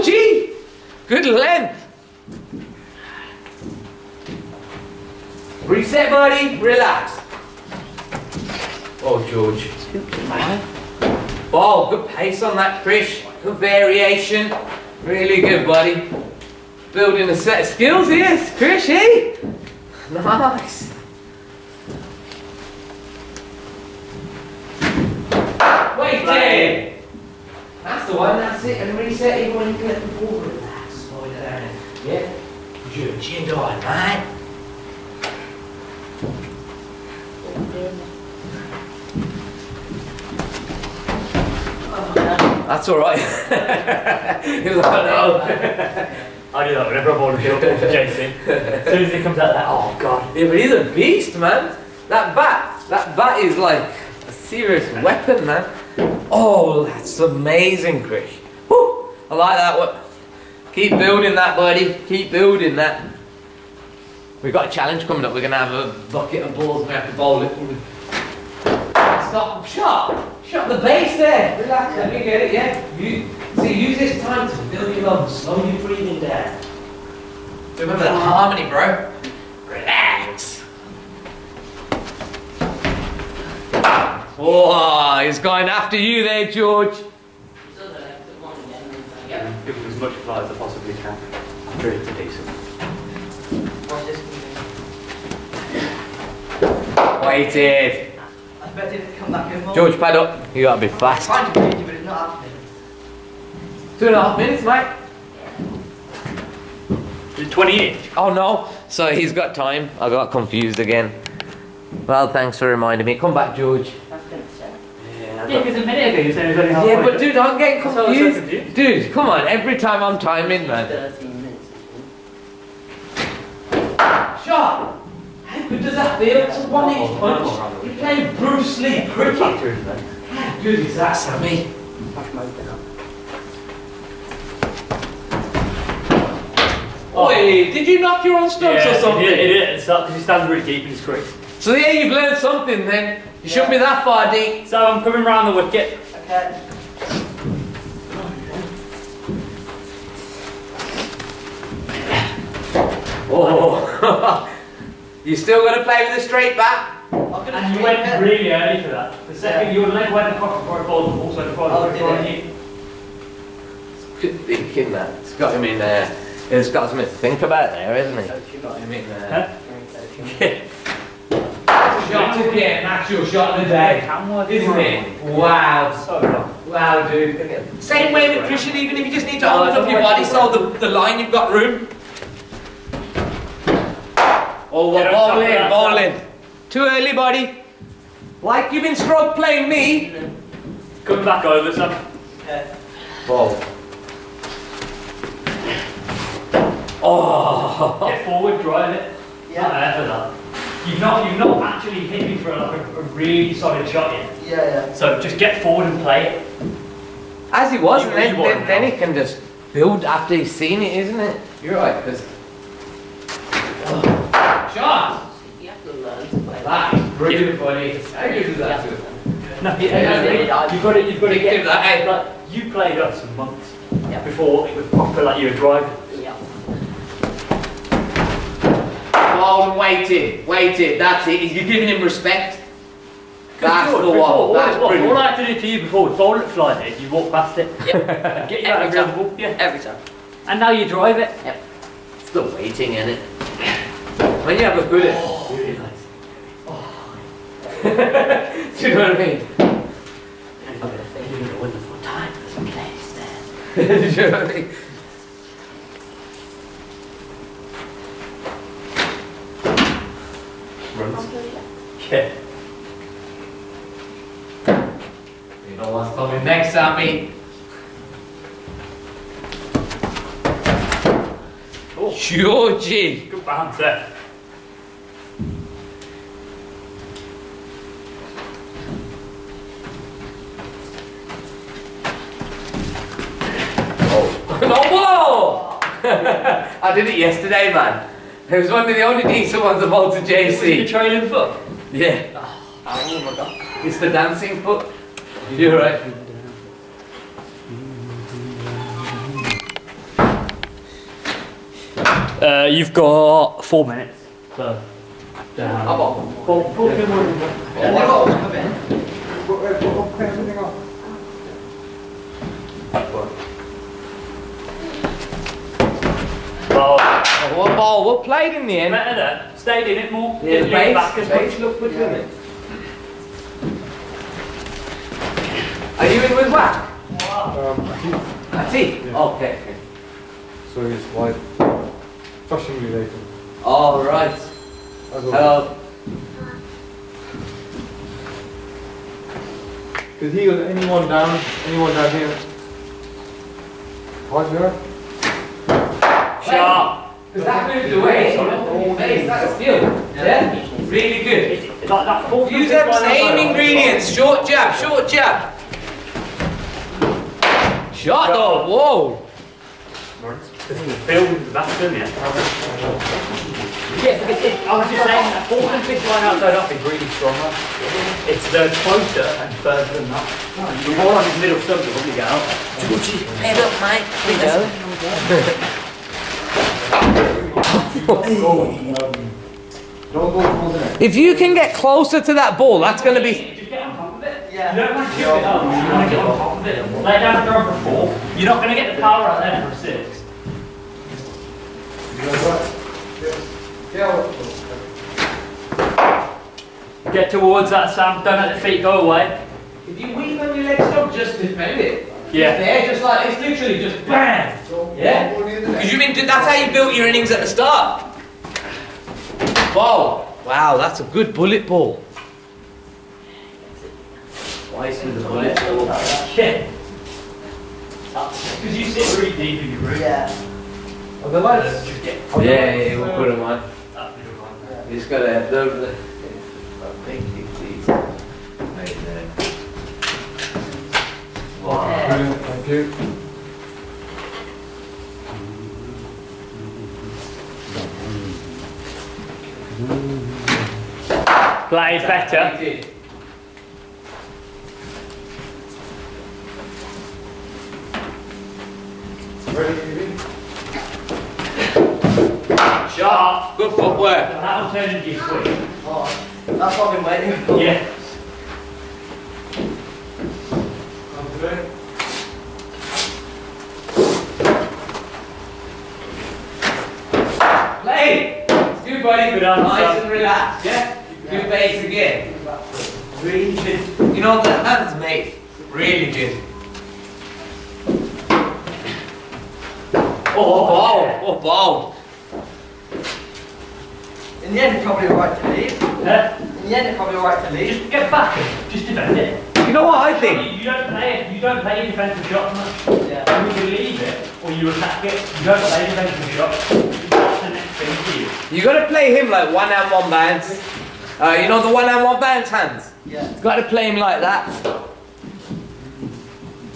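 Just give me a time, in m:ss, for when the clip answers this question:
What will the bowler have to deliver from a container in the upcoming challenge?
1:06.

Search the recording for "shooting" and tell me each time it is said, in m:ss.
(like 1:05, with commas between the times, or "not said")
not said.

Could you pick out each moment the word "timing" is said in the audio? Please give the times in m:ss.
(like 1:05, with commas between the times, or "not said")
2:00.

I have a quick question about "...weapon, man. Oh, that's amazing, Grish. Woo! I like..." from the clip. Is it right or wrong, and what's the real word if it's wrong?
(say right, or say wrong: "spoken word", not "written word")
right.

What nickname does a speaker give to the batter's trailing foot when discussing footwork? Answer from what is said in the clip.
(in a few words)
The dancing foot.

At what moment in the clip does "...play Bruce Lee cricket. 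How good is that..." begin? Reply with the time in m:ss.
2:07.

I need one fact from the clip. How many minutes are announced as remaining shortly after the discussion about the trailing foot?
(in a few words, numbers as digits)
4.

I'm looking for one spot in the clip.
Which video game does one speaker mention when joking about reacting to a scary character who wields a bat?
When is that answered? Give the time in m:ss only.
0:47.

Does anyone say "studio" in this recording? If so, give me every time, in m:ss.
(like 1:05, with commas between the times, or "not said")
not said.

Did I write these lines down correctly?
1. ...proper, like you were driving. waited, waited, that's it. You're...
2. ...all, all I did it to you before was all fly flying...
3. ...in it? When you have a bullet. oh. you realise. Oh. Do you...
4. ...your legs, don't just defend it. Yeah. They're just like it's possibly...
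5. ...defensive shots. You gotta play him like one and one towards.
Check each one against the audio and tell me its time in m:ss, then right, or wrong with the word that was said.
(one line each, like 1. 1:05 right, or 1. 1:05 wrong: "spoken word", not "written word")
1. 3:44 right
2. 3:54 right
3. 4:02 right
4. 6:40 wrong: "literally", not "possibly"
5. 8:15 wrong: "bands", not "towards".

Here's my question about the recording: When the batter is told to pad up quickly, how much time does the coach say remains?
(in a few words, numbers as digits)
2 and a half minutes.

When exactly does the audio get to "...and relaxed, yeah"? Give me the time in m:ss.
7:50.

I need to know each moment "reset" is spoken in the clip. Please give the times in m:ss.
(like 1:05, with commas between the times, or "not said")
0:05, 0:28.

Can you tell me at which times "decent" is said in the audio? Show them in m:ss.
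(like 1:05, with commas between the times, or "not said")
1:32, 4:49.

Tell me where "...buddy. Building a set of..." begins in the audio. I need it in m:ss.
0:15.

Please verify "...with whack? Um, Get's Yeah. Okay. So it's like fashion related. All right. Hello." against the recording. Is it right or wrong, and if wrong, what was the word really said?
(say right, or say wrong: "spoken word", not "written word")
wrong: "That", not "Get".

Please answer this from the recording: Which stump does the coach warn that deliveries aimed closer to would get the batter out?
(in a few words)
Middle stump.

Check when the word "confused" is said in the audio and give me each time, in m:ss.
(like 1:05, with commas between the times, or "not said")
1:50, 1:57.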